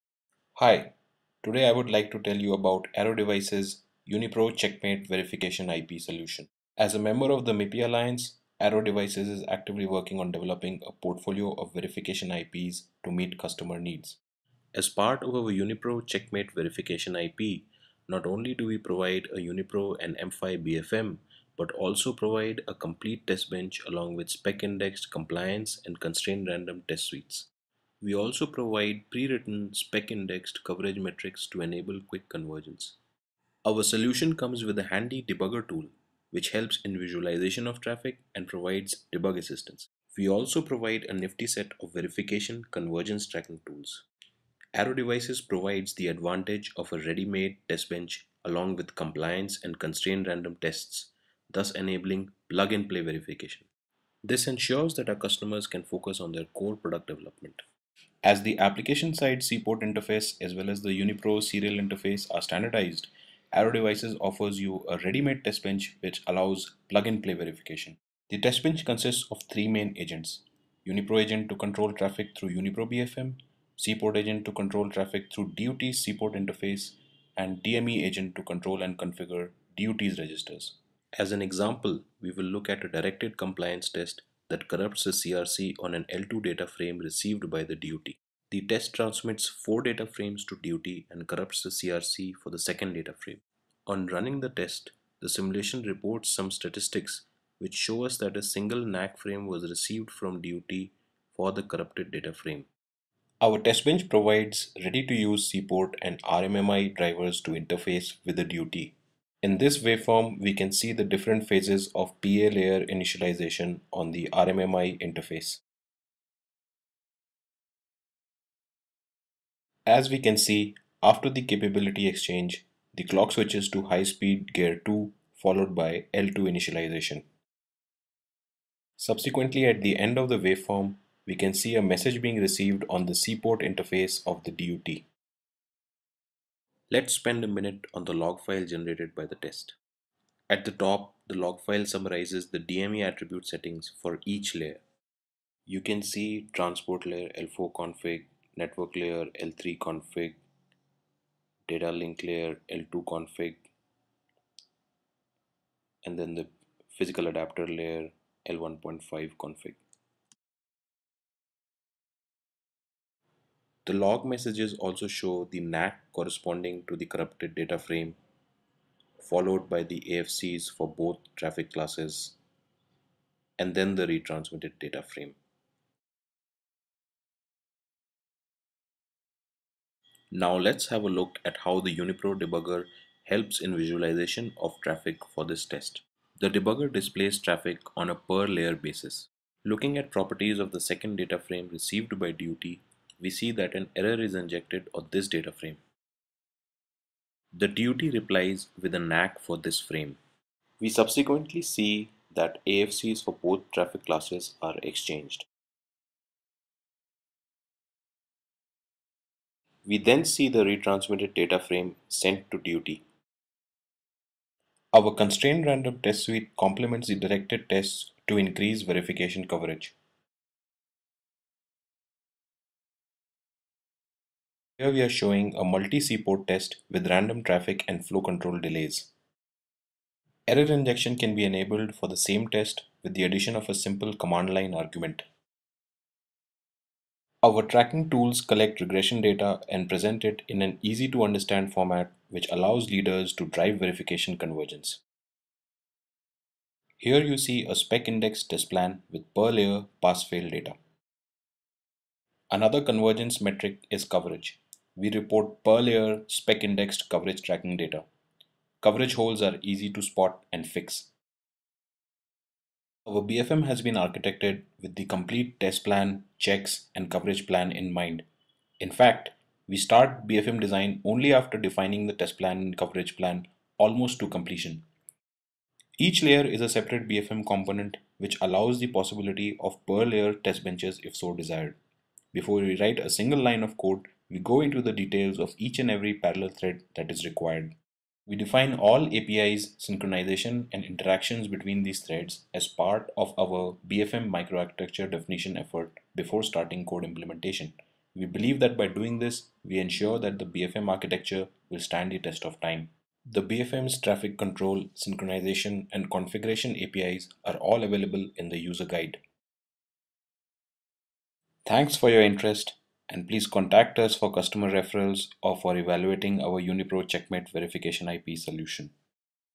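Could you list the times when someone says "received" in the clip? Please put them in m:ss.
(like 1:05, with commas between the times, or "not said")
1:26, 1:39, 2:12, 3:11.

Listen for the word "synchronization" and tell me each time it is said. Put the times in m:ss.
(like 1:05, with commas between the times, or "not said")
4:49, 5:04.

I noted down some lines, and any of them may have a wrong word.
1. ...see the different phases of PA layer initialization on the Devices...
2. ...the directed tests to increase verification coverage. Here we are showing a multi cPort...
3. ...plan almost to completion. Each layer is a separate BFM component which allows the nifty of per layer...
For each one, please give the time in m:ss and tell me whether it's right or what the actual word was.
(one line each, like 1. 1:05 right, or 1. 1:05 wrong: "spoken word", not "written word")
1. 1:50 wrong: "RMMI", not "Devices"
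2. 3:37 right
3. 4:33 wrong: "possibility", not "nifty".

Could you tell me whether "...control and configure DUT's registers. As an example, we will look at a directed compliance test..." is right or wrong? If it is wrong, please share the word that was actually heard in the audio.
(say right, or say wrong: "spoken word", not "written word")
right.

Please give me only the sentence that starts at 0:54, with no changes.
This ensures that our customers can focus on their core product development.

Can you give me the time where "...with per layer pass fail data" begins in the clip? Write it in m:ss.
4:09.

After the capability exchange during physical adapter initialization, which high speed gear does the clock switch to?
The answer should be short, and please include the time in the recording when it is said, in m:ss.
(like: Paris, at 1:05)
Gear 2, at 2:03.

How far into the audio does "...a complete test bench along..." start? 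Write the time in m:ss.
0:22.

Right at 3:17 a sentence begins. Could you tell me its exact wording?
The duty replies with a NAC for this frame.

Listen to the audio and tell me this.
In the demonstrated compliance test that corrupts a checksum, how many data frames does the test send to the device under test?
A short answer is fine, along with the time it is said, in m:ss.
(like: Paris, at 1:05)
4, at 1:29.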